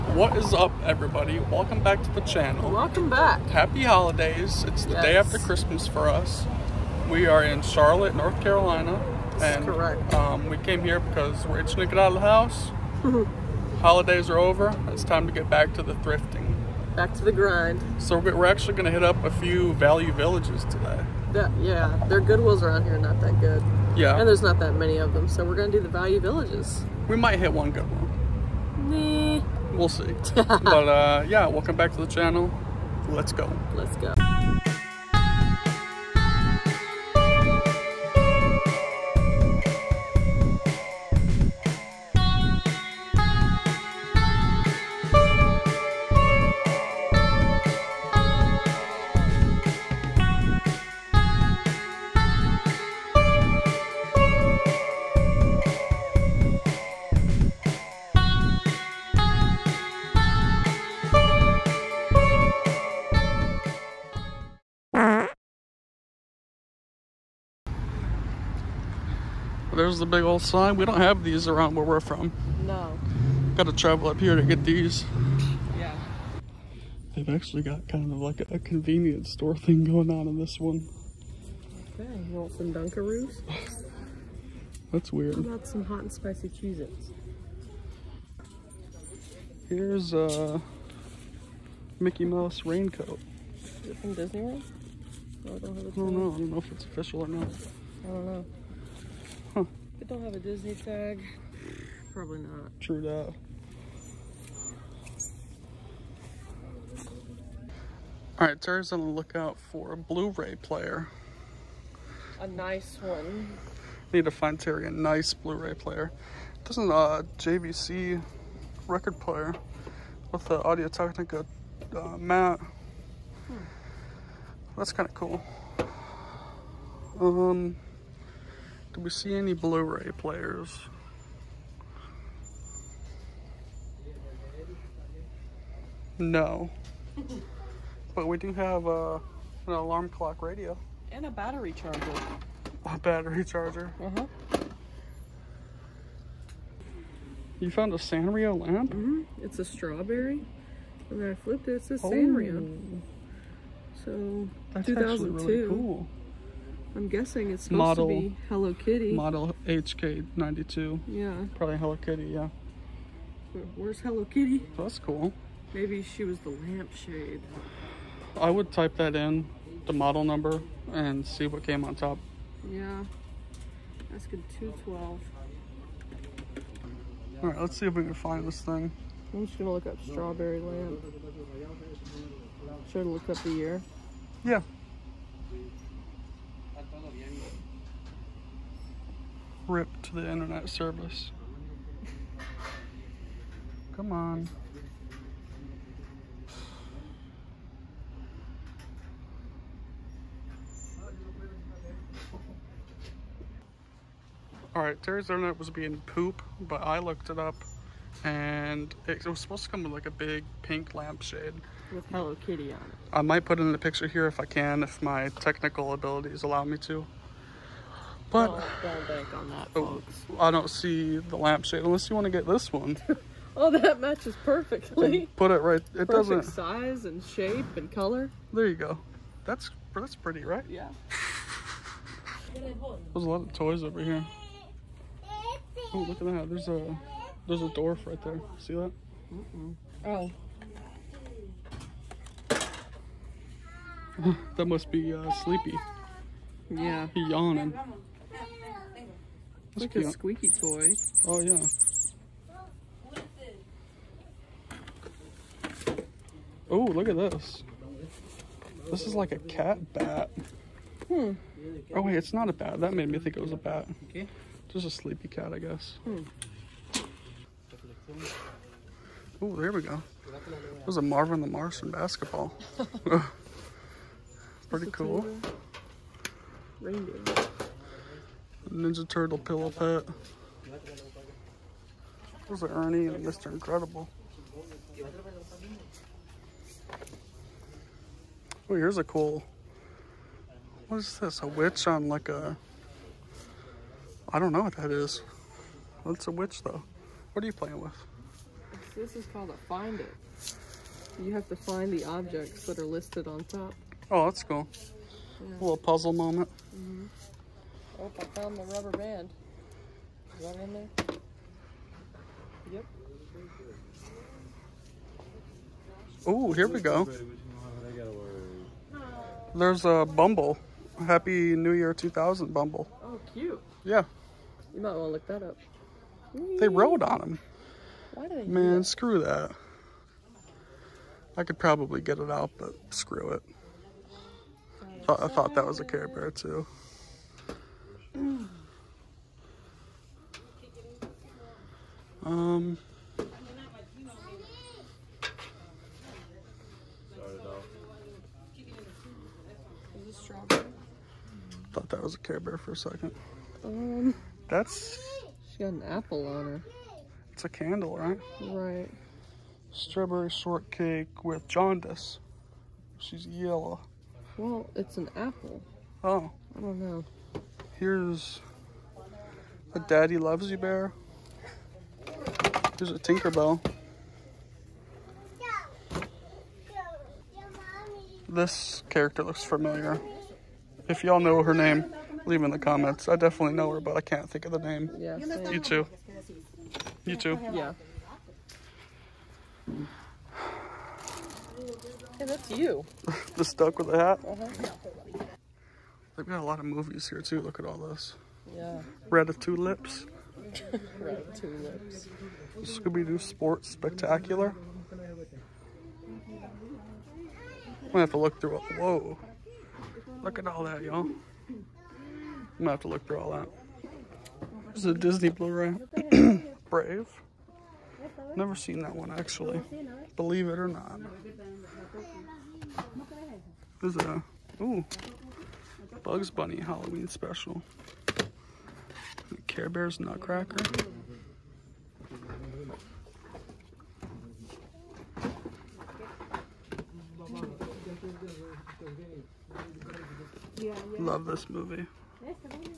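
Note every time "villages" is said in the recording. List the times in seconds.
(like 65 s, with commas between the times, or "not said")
20 s, 26 s.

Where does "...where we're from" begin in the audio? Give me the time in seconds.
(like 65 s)
71 s.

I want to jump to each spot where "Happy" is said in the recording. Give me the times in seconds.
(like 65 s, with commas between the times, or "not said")
3 s, 321 s.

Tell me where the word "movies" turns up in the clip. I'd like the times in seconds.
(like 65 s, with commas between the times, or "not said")
396 s, 441 s.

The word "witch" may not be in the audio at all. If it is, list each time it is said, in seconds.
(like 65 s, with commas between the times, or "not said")
291 s, 296 s.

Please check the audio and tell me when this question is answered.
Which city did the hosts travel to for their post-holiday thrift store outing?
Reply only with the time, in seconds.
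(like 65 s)
7 s.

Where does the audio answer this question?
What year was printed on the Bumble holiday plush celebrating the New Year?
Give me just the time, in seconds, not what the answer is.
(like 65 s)
321 s.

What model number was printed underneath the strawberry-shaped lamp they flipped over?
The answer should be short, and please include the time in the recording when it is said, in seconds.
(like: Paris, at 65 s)
HK92, at 159 s.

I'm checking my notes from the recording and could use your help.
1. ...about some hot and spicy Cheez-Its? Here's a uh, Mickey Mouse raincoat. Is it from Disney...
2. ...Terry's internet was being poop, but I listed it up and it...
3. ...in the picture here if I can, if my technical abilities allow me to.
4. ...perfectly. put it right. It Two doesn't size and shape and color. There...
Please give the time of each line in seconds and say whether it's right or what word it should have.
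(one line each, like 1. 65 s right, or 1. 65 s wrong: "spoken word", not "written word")
1. 85 s right
2. 205 s wrong: "looked", not "listed"
3. 213 s right
4. 224 s wrong: "Perfect", not "Two".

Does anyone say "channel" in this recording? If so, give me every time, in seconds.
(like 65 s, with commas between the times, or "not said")
2 s, 32 s.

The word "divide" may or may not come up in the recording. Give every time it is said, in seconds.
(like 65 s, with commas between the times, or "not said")
not said.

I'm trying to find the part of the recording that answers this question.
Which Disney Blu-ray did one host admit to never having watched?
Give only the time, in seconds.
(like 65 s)
416 s.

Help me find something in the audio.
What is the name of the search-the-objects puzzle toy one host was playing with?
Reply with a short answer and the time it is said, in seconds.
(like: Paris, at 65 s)
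Find it, at 299 s.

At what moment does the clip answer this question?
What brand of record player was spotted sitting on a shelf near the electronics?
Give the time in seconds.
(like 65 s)
117 s.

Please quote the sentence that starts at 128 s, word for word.
Do we see any Blu-ray players?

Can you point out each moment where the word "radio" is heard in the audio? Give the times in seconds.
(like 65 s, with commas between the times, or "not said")
140 s.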